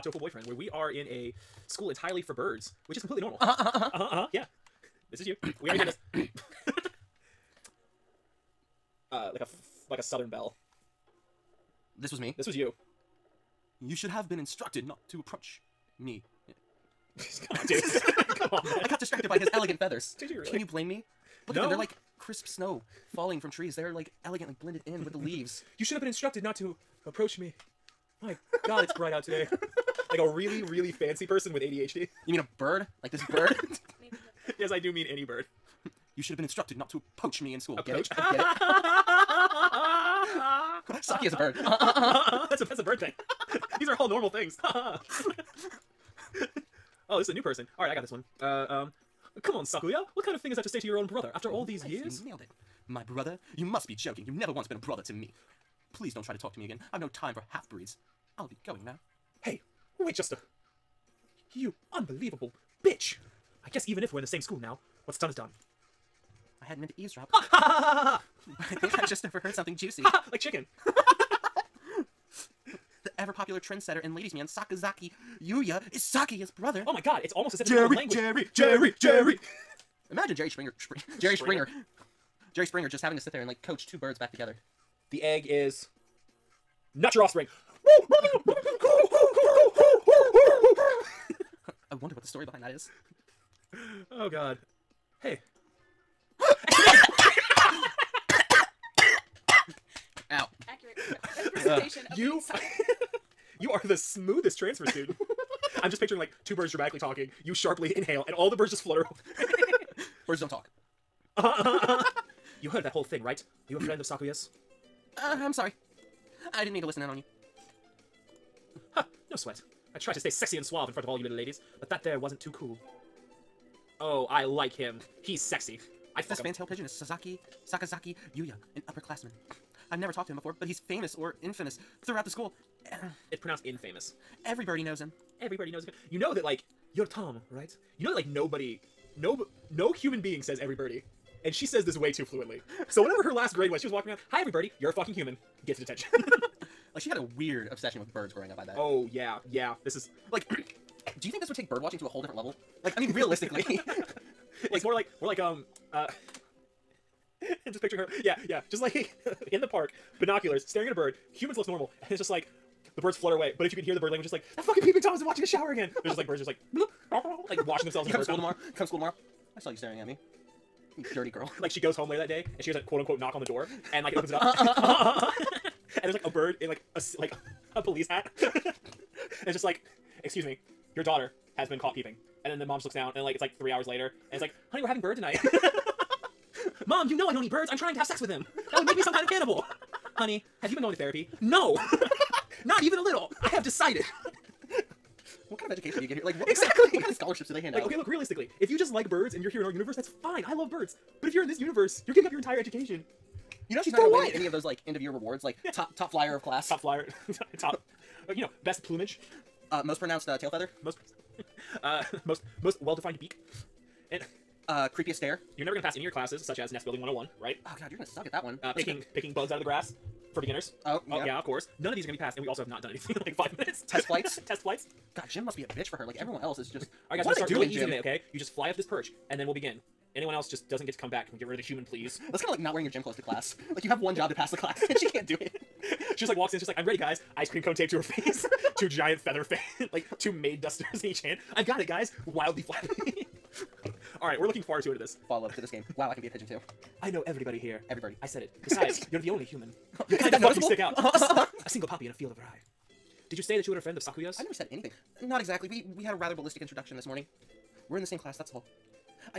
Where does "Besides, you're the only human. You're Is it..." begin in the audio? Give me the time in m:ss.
4:08.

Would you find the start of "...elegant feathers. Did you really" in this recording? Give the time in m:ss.
0:19.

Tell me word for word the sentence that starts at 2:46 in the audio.
There's just like birds, just like bloop, like washing themselves.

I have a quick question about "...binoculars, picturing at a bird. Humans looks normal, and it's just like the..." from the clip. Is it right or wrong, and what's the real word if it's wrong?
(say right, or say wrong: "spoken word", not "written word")
wrong: "staring", not "picturing".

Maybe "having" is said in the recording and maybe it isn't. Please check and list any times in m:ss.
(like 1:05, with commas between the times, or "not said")
1:23, 3:04.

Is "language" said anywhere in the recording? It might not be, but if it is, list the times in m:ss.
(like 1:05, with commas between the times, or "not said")
1:17, 2:44.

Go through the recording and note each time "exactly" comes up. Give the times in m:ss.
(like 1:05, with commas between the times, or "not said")
3:16, 4:15.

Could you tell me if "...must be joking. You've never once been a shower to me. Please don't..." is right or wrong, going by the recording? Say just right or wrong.
wrong.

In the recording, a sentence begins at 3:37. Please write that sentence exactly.
Oh god, you're going to suck at that one.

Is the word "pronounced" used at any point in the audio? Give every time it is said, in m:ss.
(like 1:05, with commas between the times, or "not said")
2:13, 3:30.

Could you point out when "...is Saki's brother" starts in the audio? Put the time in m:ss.
1:15.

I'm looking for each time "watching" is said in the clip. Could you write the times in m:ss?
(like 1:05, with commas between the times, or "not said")
2:31, 2:45.